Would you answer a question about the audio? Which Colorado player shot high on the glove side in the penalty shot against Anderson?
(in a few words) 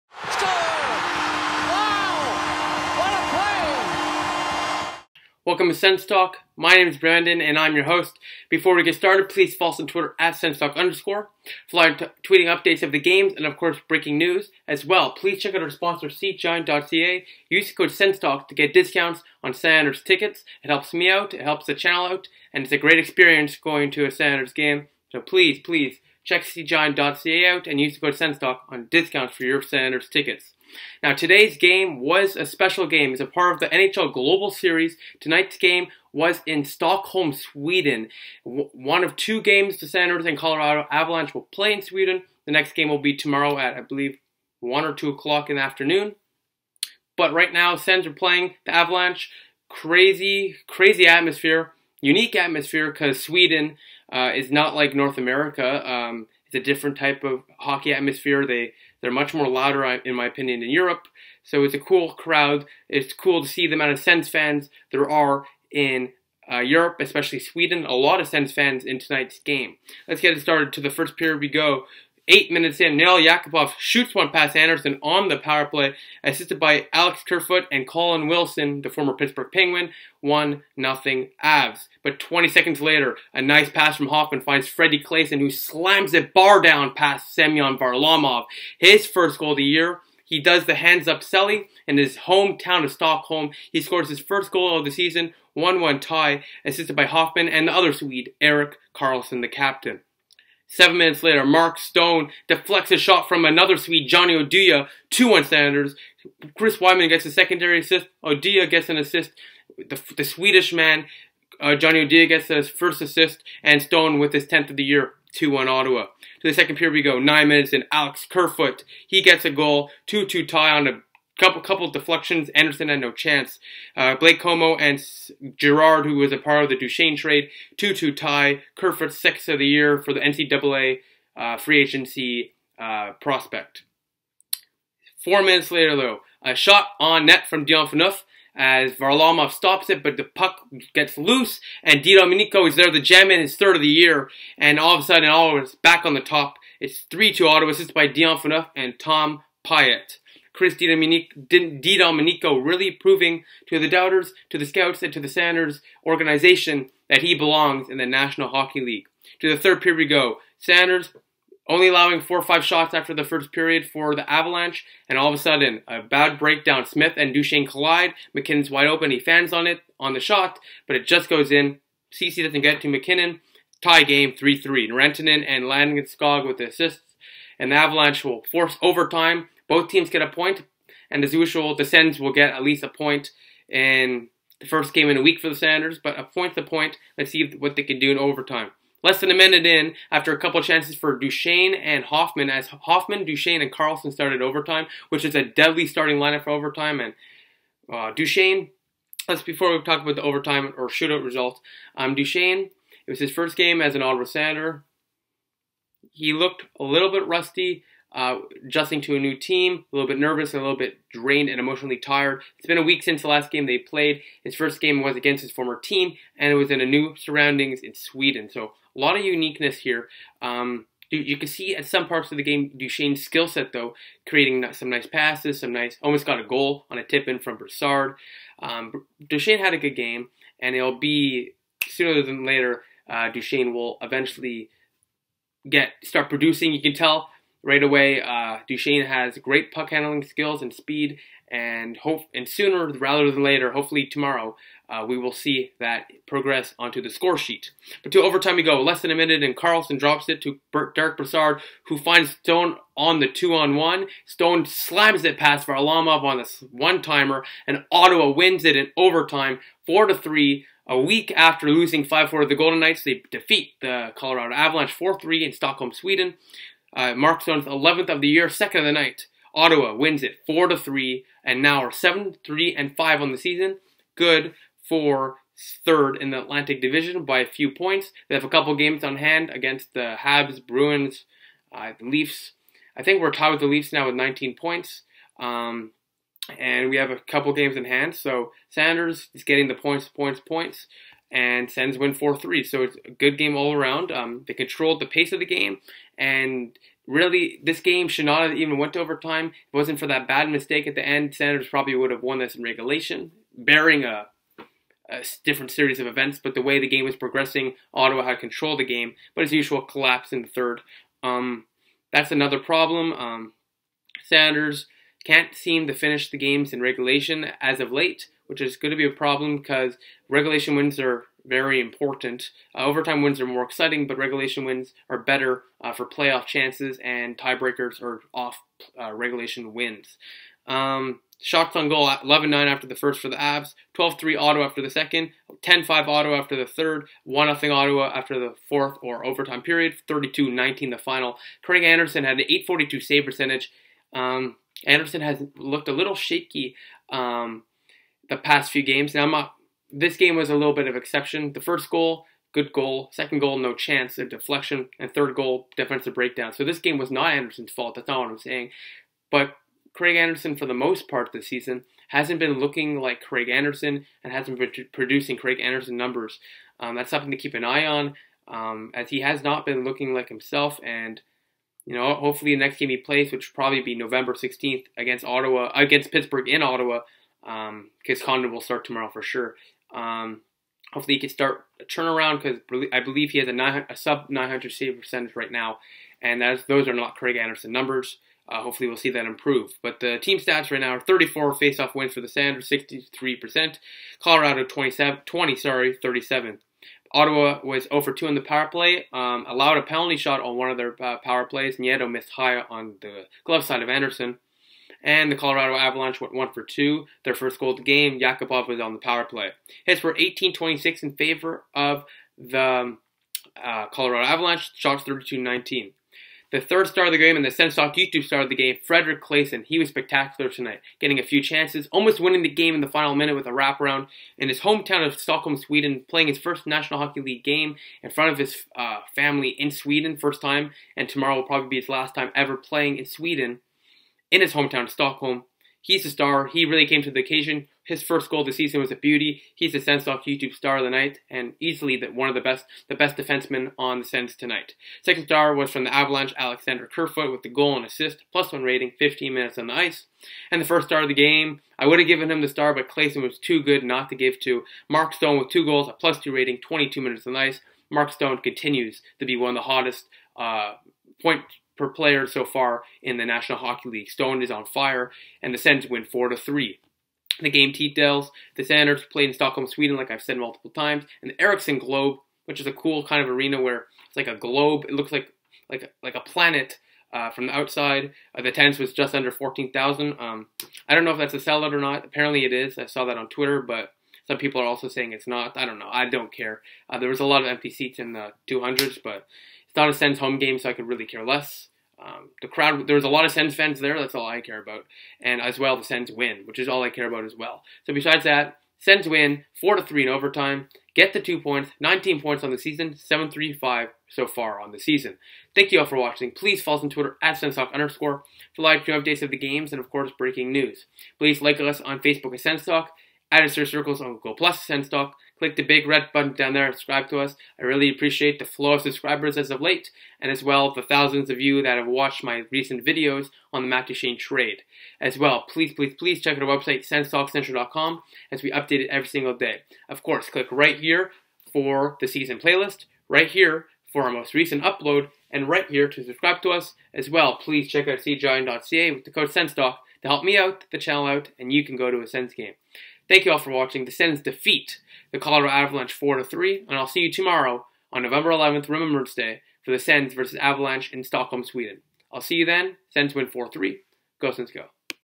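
Nieto.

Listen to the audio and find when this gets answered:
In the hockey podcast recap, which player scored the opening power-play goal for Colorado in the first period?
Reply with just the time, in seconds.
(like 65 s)
72 s.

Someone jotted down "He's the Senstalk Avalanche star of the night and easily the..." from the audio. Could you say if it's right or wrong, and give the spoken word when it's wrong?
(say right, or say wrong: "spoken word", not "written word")
wrong: "YouTube", not "Avalanche".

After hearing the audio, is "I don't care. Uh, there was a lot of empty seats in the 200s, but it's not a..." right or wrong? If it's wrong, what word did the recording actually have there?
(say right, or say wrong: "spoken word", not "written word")
right.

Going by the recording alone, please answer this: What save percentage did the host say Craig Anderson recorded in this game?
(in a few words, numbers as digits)
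.842.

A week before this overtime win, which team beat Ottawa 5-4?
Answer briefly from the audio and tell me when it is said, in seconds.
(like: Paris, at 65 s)
Golden Knights, at 262 s.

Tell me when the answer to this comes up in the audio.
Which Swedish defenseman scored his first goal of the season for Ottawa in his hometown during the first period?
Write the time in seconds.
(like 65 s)
84 s.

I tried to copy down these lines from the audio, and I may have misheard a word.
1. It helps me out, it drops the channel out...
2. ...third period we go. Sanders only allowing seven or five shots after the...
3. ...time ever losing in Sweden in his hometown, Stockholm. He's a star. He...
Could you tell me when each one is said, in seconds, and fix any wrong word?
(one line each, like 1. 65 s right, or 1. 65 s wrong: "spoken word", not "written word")
1. 20 s wrong: "helps", not "drops"
2. 159 s wrong: "four", not "seven"
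3. 432 s wrong: "playing", not "losing".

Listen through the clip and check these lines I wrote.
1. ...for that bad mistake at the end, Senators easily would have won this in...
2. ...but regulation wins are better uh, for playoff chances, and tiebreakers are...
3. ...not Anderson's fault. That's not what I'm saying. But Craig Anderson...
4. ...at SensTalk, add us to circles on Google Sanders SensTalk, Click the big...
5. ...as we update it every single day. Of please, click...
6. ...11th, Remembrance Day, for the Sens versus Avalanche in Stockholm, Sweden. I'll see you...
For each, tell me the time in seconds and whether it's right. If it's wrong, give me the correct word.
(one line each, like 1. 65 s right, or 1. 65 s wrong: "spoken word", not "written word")
1. 299 s wrong: "probably", not "easily"
2. 324 s right
3. 357 s right
4. 512 s wrong: "Plus", not "Sanders"
5. 528 s wrong: "course", not "please"
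6. 548 s right.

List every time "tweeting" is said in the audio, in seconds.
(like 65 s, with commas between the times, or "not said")
12 s.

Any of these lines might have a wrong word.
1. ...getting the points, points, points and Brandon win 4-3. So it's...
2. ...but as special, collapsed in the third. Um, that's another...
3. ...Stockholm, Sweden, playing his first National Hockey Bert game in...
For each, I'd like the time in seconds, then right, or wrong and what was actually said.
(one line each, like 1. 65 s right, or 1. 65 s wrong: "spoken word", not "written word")
1. 289 s wrong: "Sens", not "Brandon"
2. 309 s wrong: "usual", not "special"
3. 425 s wrong: "League", not "Bert".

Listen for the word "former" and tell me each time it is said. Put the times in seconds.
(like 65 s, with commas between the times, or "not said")
78 s, 215 s.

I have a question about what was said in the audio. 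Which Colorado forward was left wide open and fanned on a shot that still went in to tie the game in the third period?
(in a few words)
MacKinnon.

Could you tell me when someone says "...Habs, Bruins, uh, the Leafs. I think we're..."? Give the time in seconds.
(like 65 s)
280 s.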